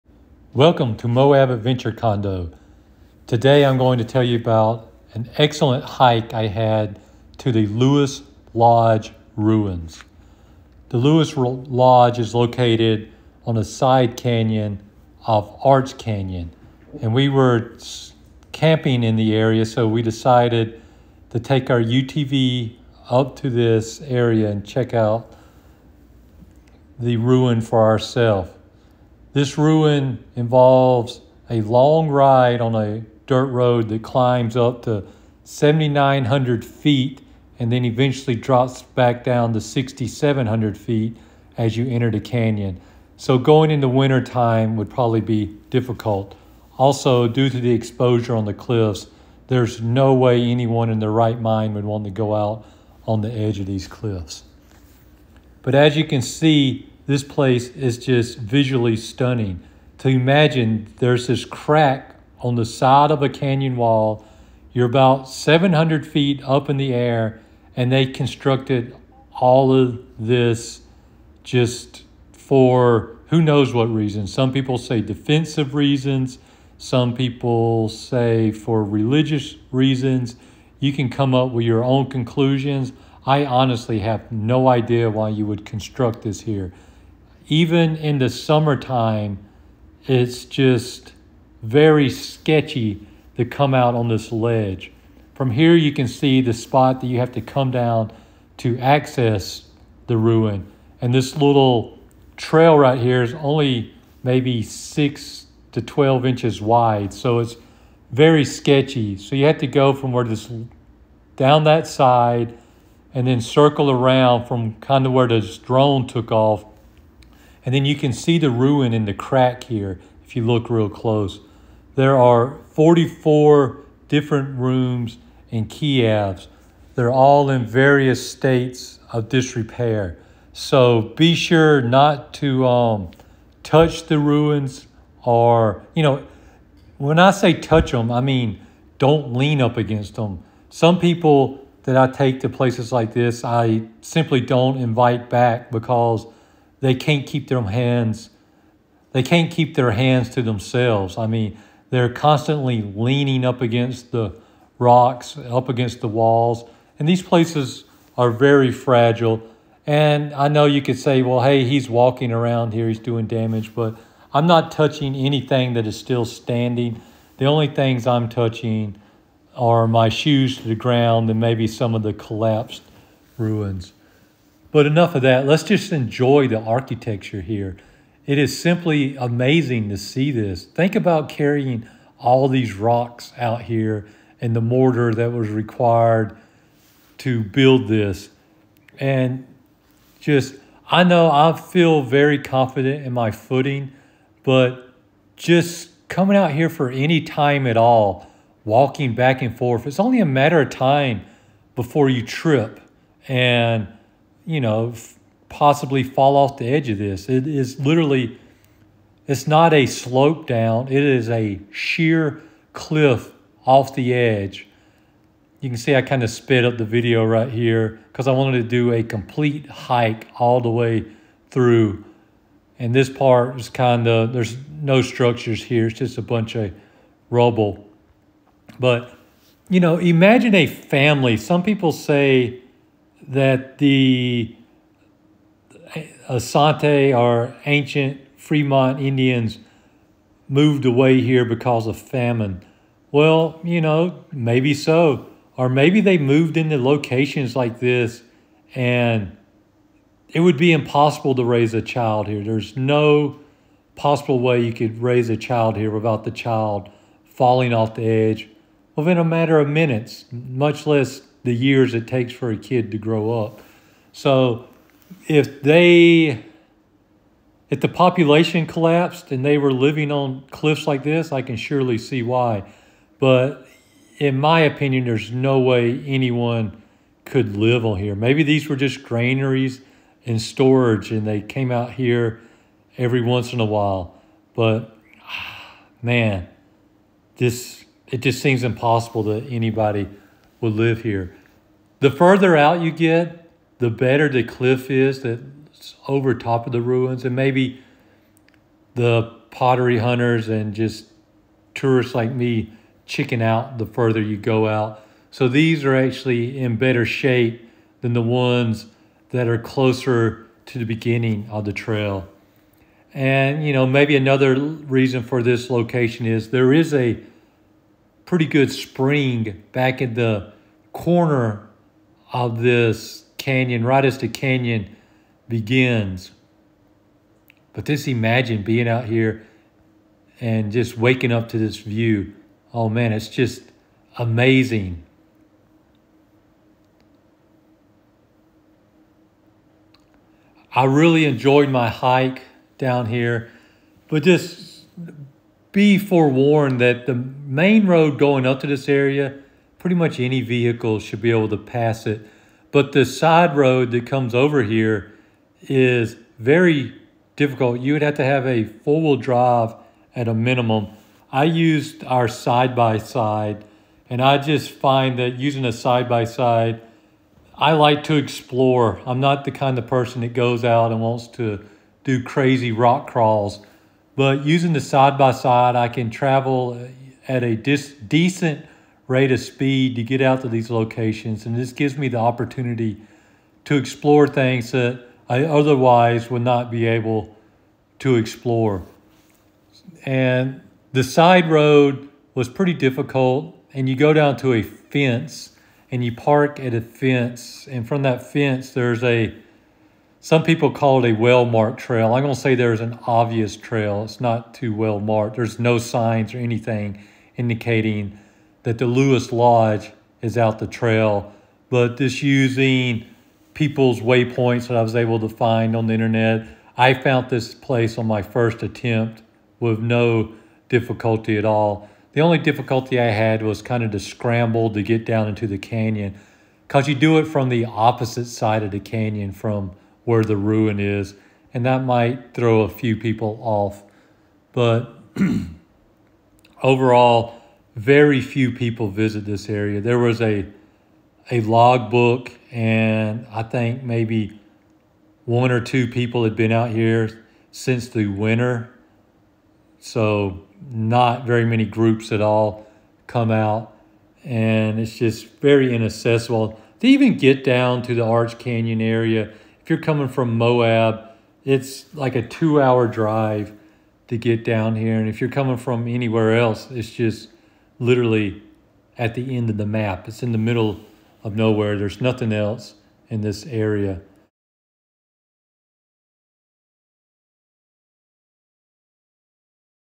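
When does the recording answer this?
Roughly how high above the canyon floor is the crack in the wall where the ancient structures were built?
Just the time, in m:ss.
1:05.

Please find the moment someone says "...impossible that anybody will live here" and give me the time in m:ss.
4:48.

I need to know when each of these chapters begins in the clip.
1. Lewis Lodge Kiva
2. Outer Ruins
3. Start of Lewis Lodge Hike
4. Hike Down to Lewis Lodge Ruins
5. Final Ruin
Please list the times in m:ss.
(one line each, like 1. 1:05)
1. 0:43
2. 4:08
3. 0:17
4. 1:35
5. 6:26.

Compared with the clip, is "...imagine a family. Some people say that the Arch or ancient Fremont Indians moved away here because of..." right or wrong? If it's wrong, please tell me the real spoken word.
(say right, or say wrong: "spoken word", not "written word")
wrong: "Anasazi", not "Arch".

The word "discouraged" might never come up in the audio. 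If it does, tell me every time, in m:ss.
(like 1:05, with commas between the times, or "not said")
not said.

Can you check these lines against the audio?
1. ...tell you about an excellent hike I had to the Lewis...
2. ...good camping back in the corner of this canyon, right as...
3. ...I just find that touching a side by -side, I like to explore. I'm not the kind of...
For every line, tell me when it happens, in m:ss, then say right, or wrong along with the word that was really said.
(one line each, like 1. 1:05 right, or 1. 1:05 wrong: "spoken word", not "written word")
1. 0:04 right
2. 5:18 wrong: "spring", not "camping"
3. 6:04 wrong: "using", not "touching".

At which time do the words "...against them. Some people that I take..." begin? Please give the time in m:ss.
2:19.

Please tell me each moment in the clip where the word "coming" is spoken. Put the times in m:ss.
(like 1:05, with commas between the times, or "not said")
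3:16, 7:39, 7:45.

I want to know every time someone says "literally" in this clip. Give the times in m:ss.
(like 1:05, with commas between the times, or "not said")
3:27, 7:47.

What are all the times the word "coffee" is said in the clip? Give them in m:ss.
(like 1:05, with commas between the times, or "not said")
not said.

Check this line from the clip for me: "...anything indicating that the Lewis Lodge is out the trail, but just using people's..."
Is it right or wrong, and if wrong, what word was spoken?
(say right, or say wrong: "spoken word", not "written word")
right.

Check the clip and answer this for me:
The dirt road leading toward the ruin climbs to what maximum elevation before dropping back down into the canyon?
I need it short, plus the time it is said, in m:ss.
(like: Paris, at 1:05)
7,900 feet, at 0:35.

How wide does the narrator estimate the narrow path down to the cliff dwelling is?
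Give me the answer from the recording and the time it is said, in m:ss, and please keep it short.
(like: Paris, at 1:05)
6 to 12 inches, at 1:44.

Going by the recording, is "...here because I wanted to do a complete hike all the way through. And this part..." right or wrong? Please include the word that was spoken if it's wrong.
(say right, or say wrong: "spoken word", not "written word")
right.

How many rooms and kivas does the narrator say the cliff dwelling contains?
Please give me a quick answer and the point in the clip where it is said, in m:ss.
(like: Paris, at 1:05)
44, at 2:02.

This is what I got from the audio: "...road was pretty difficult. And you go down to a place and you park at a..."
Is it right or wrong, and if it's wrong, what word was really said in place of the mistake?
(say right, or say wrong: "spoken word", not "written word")
wrong: "fence", not "place".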